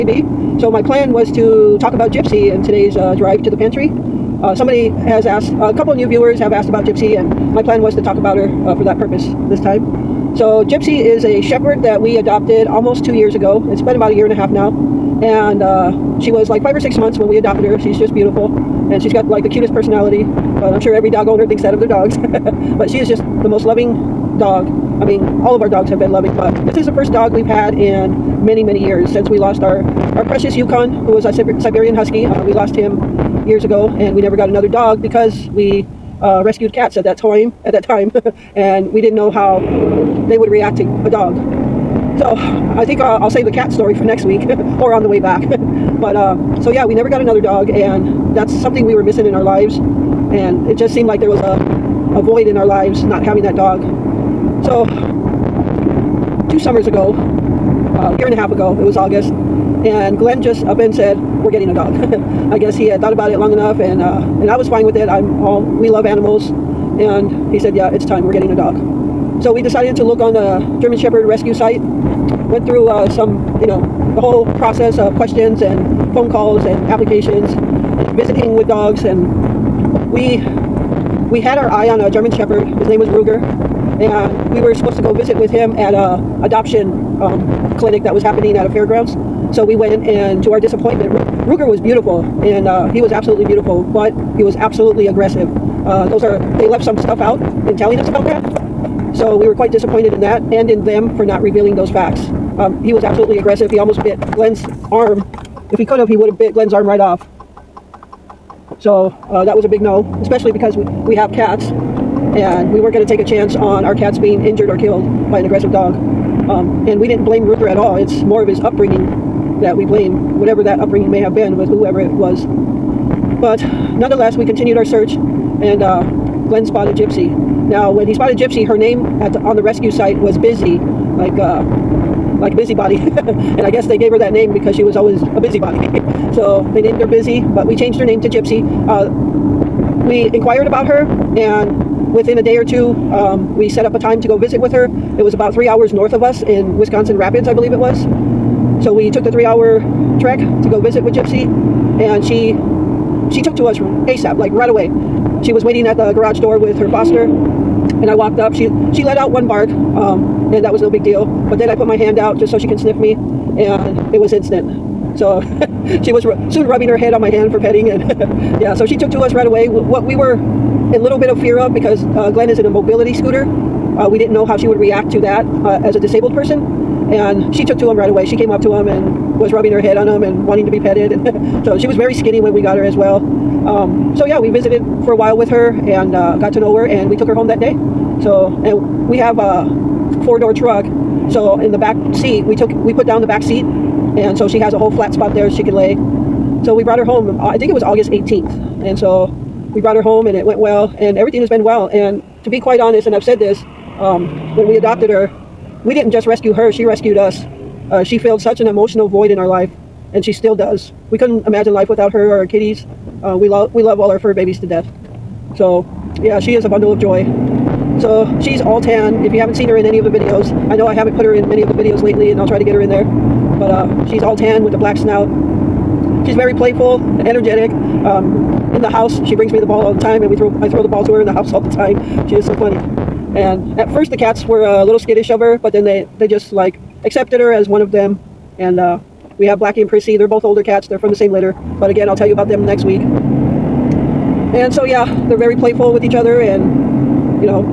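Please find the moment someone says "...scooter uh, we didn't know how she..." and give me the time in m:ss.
2:53.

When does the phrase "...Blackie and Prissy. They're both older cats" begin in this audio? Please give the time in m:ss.
3:59.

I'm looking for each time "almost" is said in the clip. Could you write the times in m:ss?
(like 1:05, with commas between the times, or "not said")
0:12, 1:43.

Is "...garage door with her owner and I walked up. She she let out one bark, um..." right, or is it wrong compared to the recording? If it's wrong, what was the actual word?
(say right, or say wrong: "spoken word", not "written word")
wrong: "foster", not "owner".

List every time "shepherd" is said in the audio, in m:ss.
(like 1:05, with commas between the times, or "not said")
0:11, 1:10, 1:22.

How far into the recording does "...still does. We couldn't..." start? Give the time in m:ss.
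3:30.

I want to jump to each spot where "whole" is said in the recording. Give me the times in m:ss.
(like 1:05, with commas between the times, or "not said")
1:14, 3:14.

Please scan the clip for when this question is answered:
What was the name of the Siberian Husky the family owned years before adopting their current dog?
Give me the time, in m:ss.
0:30.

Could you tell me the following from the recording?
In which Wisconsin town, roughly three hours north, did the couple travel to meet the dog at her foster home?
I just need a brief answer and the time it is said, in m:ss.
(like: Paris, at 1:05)
Wisconsin Rapids, at 2:26.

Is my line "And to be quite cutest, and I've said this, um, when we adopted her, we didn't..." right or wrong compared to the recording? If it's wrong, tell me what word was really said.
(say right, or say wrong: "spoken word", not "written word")
wrong: "honest", not "cutest".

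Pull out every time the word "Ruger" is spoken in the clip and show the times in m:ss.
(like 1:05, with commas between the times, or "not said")
1:23, 1:31, 1:57.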